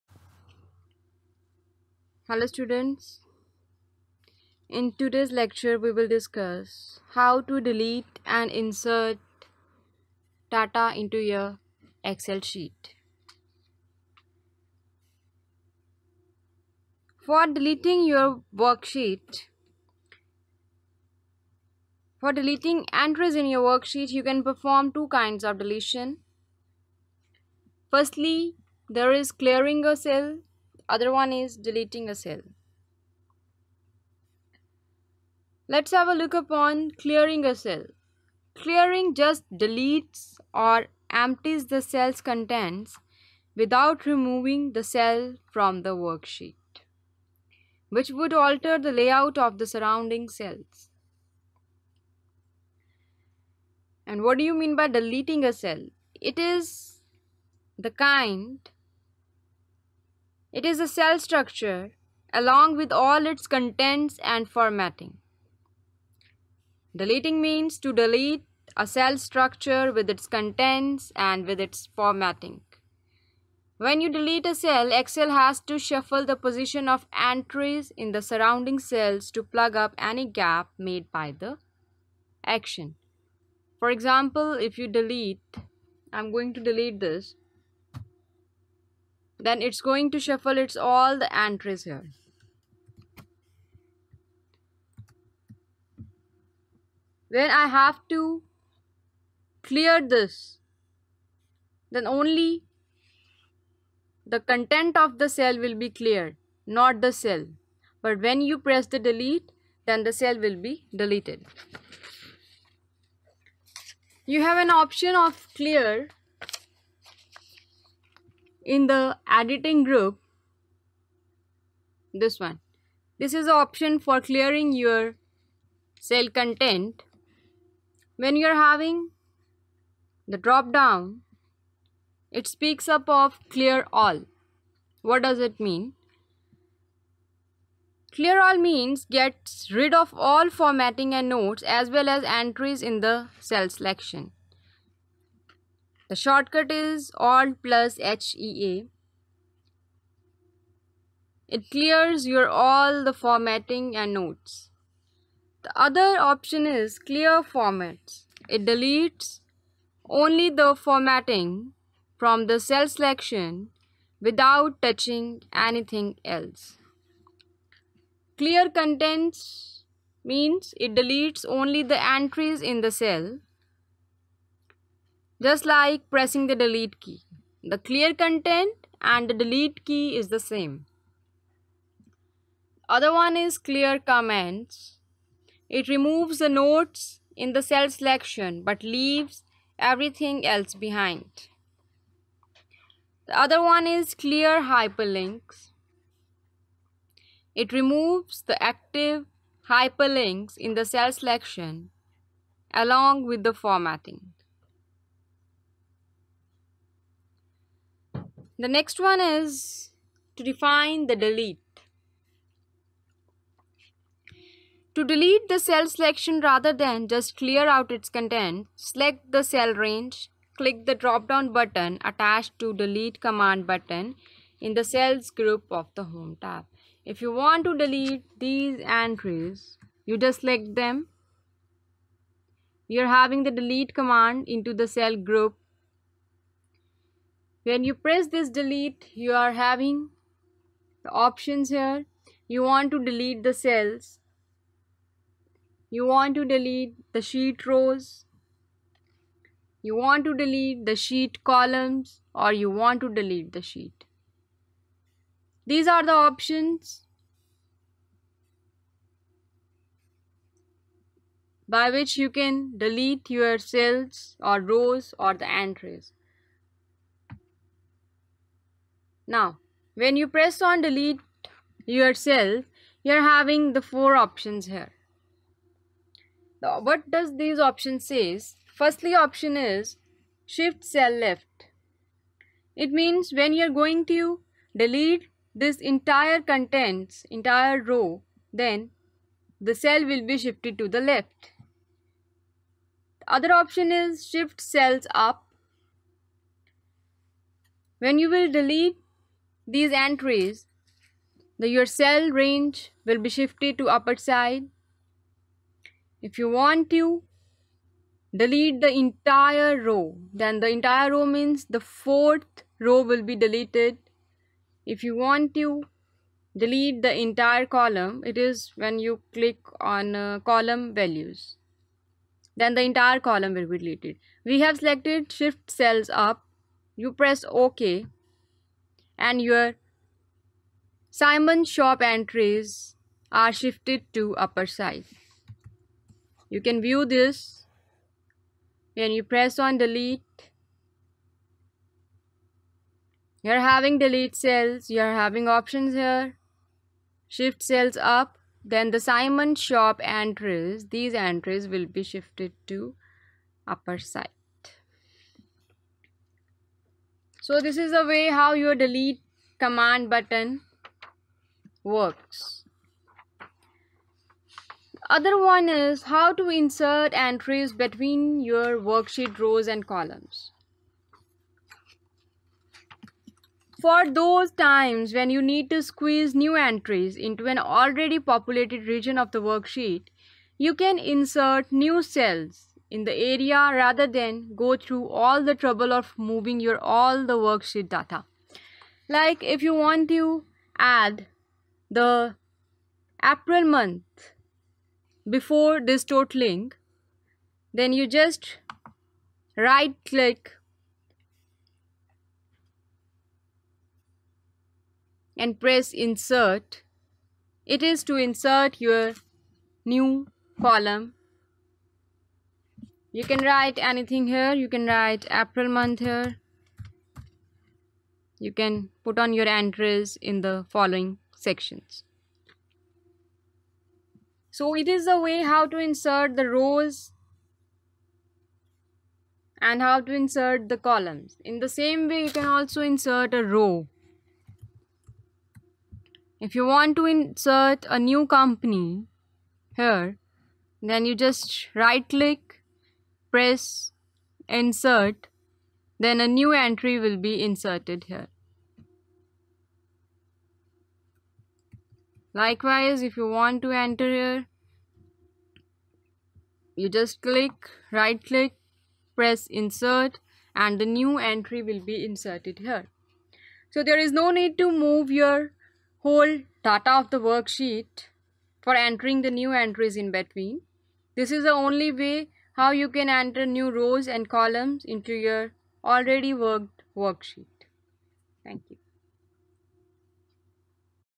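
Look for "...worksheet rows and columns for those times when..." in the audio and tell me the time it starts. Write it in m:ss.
6:08.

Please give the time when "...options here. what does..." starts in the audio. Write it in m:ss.
4:34.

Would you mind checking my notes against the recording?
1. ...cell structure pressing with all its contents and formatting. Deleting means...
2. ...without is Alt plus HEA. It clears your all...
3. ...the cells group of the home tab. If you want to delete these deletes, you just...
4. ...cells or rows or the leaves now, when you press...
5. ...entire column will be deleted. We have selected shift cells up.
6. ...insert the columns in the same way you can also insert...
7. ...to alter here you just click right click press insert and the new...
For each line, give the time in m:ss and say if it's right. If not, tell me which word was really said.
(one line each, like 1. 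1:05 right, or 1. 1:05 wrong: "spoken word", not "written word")
1. 1:00 wrong: "along", not "pressing"
2. 2:26 wrong: "shortcut", not "without"
3. 3:44 wrong: "entries", not "deletes"
4. 4:23 wrong: "entries", not "leaves"
5. 5:22 right
6. 7:10 right
7. 7:33 wrong: "enter", not "alter".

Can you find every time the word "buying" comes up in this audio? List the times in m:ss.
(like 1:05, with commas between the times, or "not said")
not said.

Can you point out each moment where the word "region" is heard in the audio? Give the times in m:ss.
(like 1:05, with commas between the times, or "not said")
6:18.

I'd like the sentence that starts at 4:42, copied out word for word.
It means when you're going to delete this entire contents, entire row, then the cell will be shifted to the left.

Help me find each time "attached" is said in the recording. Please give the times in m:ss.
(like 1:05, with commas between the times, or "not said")
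3:42.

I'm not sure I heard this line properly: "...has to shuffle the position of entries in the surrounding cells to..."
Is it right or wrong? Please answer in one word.
right.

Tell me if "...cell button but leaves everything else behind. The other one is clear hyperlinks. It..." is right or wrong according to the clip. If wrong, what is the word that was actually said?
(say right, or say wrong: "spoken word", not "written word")
wrong: "selection", not "button".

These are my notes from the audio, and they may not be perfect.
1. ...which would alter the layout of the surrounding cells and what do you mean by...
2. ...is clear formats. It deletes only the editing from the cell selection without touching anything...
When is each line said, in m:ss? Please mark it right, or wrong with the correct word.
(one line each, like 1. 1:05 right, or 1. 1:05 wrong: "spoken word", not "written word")
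1. 0:47 right
2. 2:36 wrong: "formatting", not "editing".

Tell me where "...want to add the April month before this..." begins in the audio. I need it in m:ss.
6:29.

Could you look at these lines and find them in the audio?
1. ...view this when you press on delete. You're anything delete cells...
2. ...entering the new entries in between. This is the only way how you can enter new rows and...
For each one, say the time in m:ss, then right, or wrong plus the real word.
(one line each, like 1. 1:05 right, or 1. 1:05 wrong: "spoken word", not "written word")
1. 5:36 wrong: "having", not "anything"
2. 7:48 right.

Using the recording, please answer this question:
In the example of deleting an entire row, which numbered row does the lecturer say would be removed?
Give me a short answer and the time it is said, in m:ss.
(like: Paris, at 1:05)
4th row, at 5:11.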